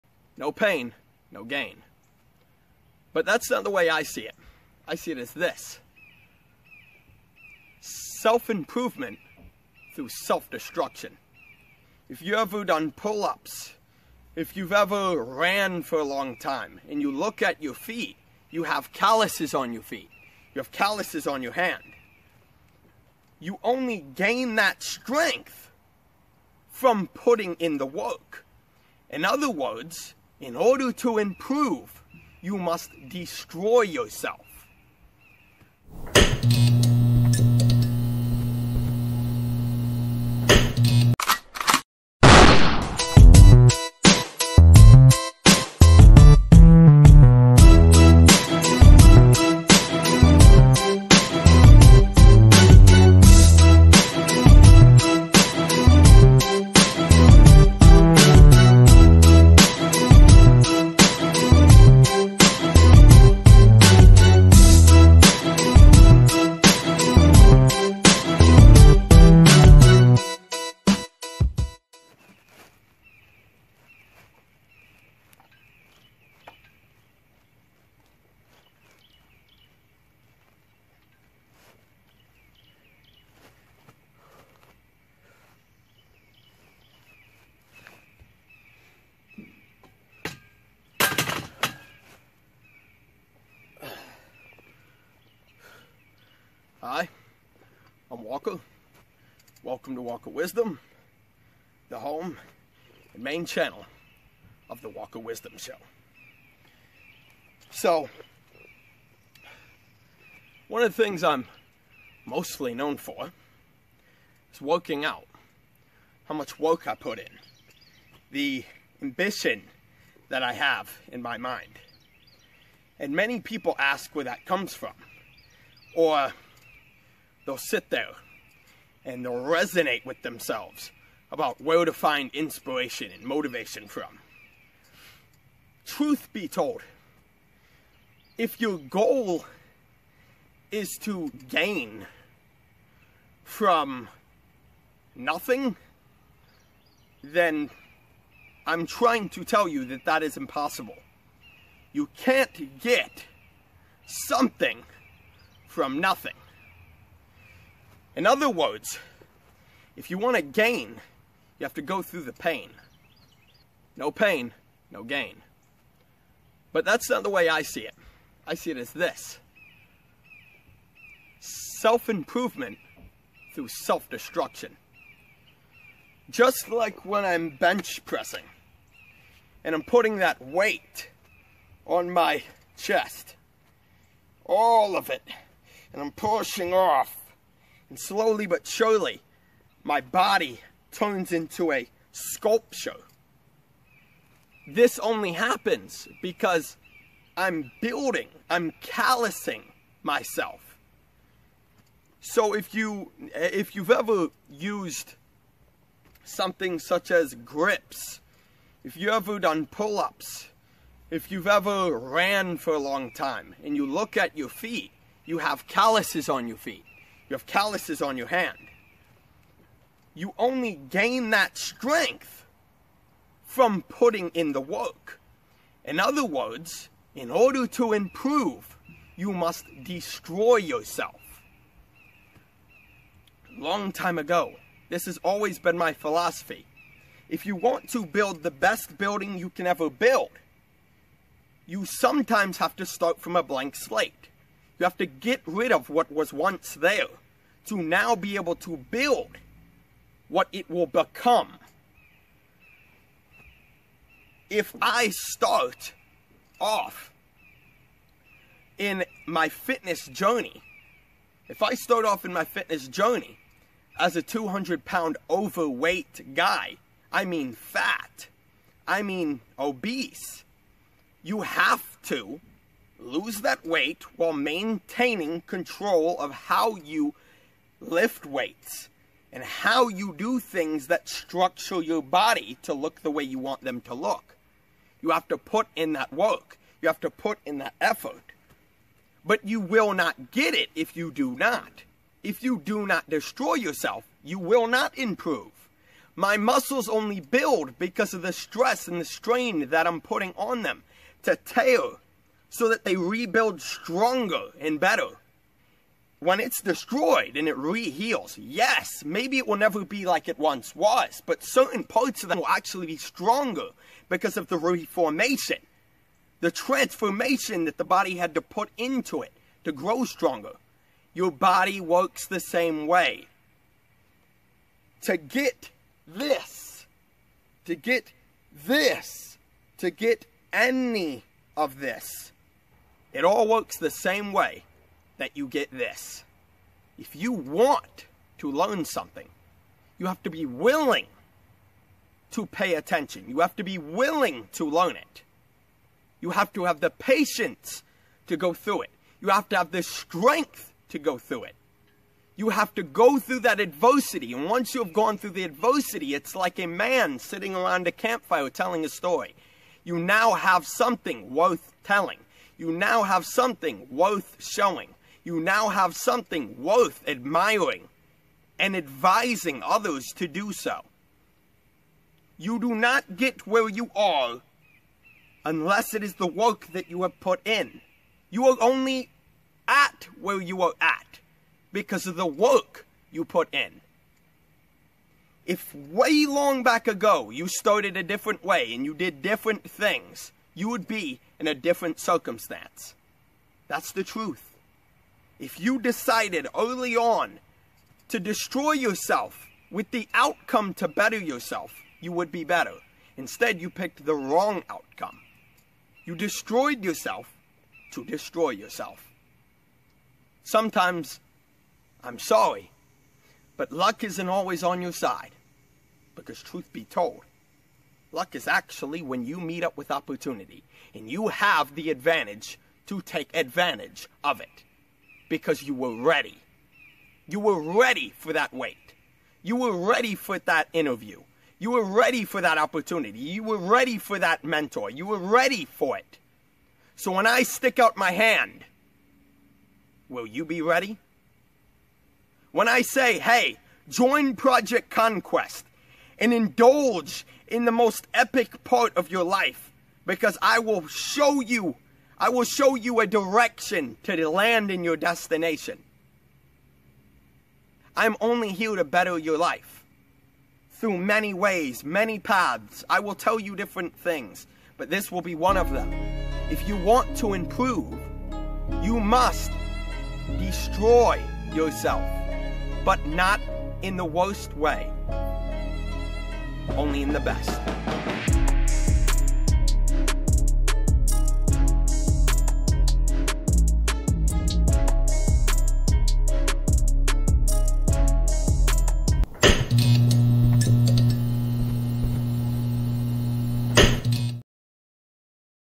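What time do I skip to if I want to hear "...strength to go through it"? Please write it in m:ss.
5:49.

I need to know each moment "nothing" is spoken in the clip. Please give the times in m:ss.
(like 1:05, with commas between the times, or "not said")
2:25, 2:35.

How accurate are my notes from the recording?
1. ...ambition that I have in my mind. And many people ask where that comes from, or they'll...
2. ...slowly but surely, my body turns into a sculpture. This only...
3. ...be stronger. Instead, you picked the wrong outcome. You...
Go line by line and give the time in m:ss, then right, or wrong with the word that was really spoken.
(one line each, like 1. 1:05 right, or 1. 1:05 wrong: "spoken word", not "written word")
1. 1:59 right
2. 3:07 right
3. 6:42 wrong: "better", not "stronger".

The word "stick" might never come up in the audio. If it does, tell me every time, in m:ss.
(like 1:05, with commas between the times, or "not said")
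7:17.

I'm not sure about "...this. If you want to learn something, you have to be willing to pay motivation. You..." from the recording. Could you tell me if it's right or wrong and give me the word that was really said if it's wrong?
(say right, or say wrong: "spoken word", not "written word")
wrong: "attention", not "motivation".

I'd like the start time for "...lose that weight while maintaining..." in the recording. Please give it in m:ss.
4:33.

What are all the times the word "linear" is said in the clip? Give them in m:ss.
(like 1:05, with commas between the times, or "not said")
not said.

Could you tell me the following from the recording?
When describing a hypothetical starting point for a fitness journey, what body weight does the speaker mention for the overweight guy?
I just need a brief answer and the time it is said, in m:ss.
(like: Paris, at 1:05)
200 pounds, at 4:24.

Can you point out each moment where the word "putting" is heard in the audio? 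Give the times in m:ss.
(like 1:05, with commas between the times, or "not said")
0:27, 2:59, 3:43, 5:00.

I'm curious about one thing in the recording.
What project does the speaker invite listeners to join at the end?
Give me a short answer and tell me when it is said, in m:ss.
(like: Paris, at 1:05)
Project Conquest, at 7:24.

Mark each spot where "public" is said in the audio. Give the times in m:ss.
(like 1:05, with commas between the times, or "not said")
not said.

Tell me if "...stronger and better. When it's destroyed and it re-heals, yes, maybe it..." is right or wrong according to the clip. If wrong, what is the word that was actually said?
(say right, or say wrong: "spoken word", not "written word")
right.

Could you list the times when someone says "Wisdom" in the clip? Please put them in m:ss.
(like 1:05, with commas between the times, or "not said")
1:40, 1:45.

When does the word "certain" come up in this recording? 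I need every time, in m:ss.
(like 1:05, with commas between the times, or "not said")
5:11.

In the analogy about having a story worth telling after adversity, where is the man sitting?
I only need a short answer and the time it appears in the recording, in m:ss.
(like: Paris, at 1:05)
Around a campfire, at 5:57.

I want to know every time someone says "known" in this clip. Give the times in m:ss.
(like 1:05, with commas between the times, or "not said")
1:52.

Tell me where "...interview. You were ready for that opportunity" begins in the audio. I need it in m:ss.
7:10.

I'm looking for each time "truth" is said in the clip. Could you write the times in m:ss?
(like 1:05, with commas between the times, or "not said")
2:15, 6:34, 6:56.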